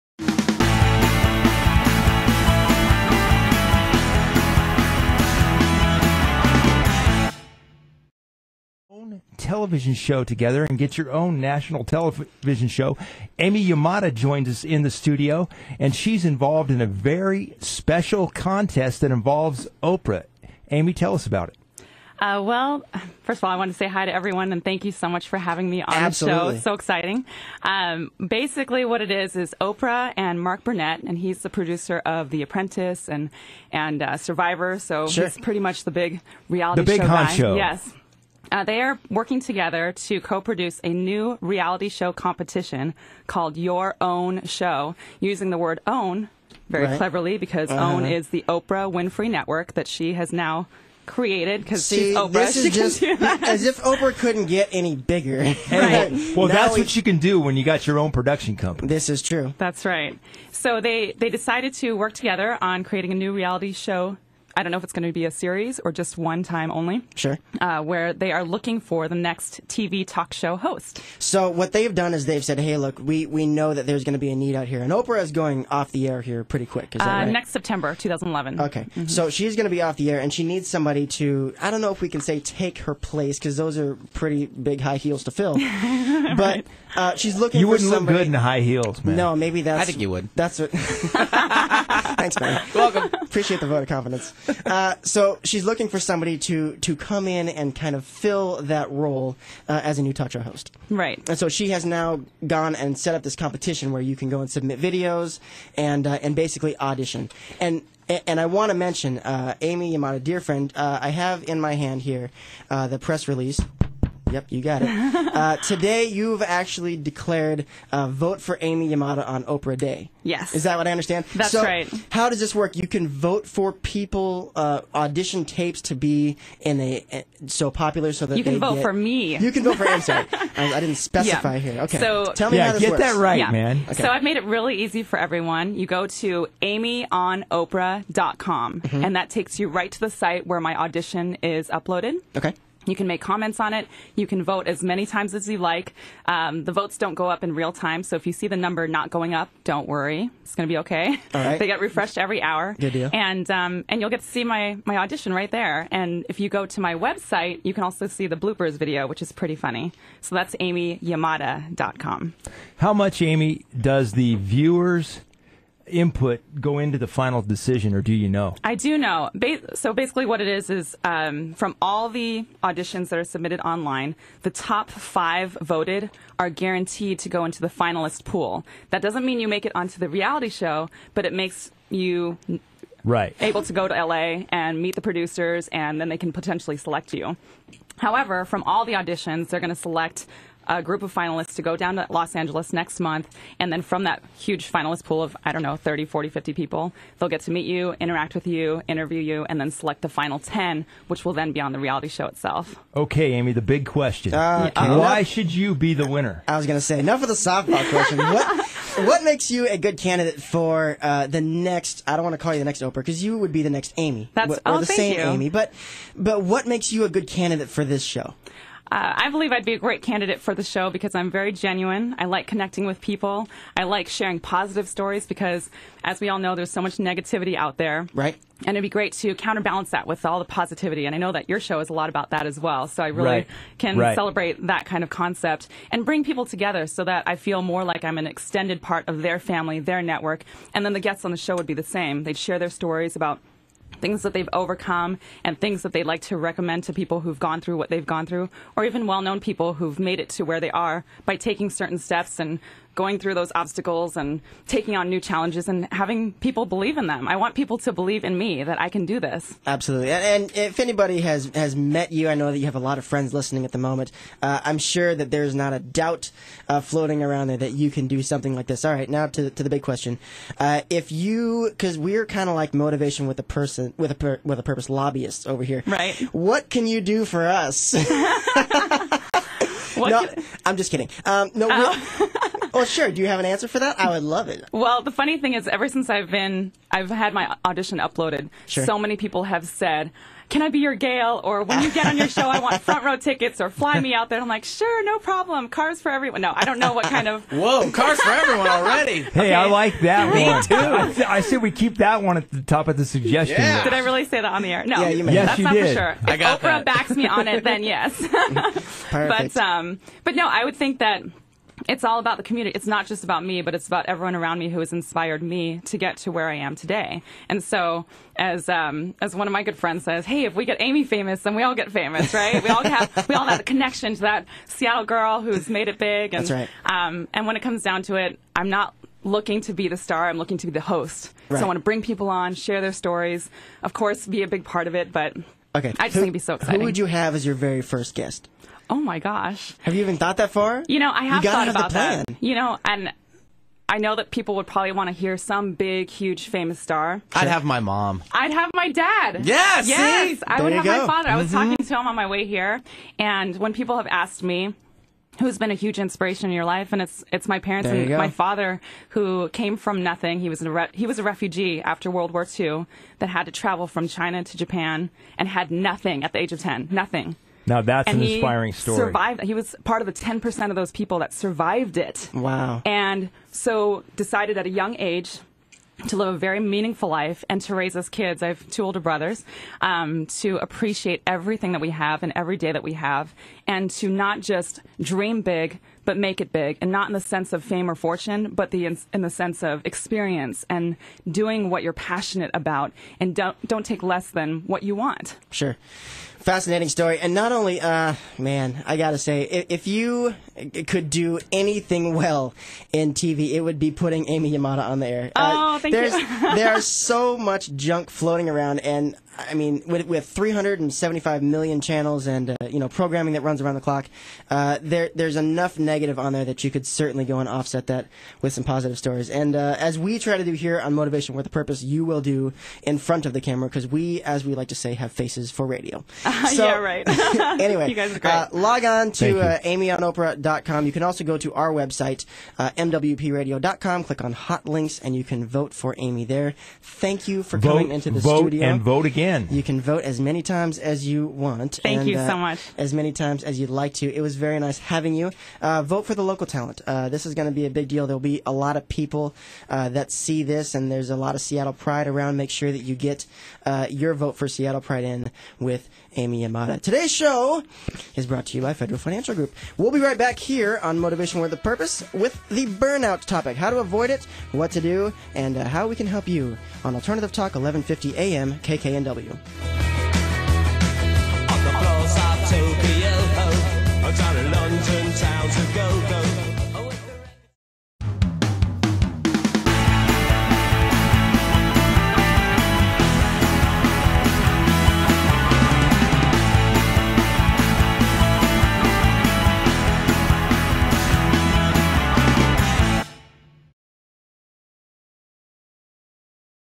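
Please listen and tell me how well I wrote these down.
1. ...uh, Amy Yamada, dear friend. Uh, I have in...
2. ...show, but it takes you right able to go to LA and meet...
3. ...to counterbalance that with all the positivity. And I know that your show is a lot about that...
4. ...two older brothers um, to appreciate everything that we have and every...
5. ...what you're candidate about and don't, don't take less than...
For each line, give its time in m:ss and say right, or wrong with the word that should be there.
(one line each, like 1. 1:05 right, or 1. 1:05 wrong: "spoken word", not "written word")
1. 1:49 right
2. 3:00 wrong: "makes", not "takes"
3. 3:49 right
4. 6:18 right
5. 6:31 wrong: "passionate", not "candidate".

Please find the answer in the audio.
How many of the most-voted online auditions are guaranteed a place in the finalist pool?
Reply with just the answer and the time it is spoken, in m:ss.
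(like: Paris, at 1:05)
5, at 2:54.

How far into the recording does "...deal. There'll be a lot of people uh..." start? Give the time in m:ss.
7:27.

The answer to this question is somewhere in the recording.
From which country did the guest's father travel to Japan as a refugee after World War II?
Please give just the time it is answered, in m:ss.
6:04.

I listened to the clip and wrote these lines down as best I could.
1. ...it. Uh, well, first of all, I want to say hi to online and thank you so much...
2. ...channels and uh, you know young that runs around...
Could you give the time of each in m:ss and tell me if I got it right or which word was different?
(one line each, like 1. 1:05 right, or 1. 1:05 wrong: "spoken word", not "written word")
1. 0:21 wrong: "everyone", not "online"
2. 6:51 wrong: "programming", not "young".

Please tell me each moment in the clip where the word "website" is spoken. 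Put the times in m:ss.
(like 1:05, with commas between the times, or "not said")
2:36, 7:11.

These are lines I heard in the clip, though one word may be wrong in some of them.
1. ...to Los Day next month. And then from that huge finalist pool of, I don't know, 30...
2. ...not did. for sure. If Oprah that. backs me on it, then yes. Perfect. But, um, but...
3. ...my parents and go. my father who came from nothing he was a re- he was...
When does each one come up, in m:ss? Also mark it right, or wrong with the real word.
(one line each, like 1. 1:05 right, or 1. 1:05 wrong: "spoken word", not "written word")
1. 3:11 wrong: "Angeles", not "Day"
2. 5:05 right
3. 5:57 right.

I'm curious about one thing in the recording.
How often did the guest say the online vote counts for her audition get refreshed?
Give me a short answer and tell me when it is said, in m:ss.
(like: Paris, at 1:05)
Every hour, at 2:32.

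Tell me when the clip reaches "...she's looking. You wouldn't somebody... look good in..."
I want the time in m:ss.
1:27.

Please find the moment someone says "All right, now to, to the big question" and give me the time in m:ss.
4:28.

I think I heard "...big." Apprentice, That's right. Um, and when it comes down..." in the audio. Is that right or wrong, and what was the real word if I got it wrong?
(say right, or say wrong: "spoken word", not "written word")
wrong: "And", not "Apprentice".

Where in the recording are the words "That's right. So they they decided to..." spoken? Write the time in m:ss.
0:59.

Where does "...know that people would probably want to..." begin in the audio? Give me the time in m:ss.
5:43.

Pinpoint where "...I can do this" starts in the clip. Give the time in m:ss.
4:18.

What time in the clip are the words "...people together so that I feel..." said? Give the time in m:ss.
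3:56.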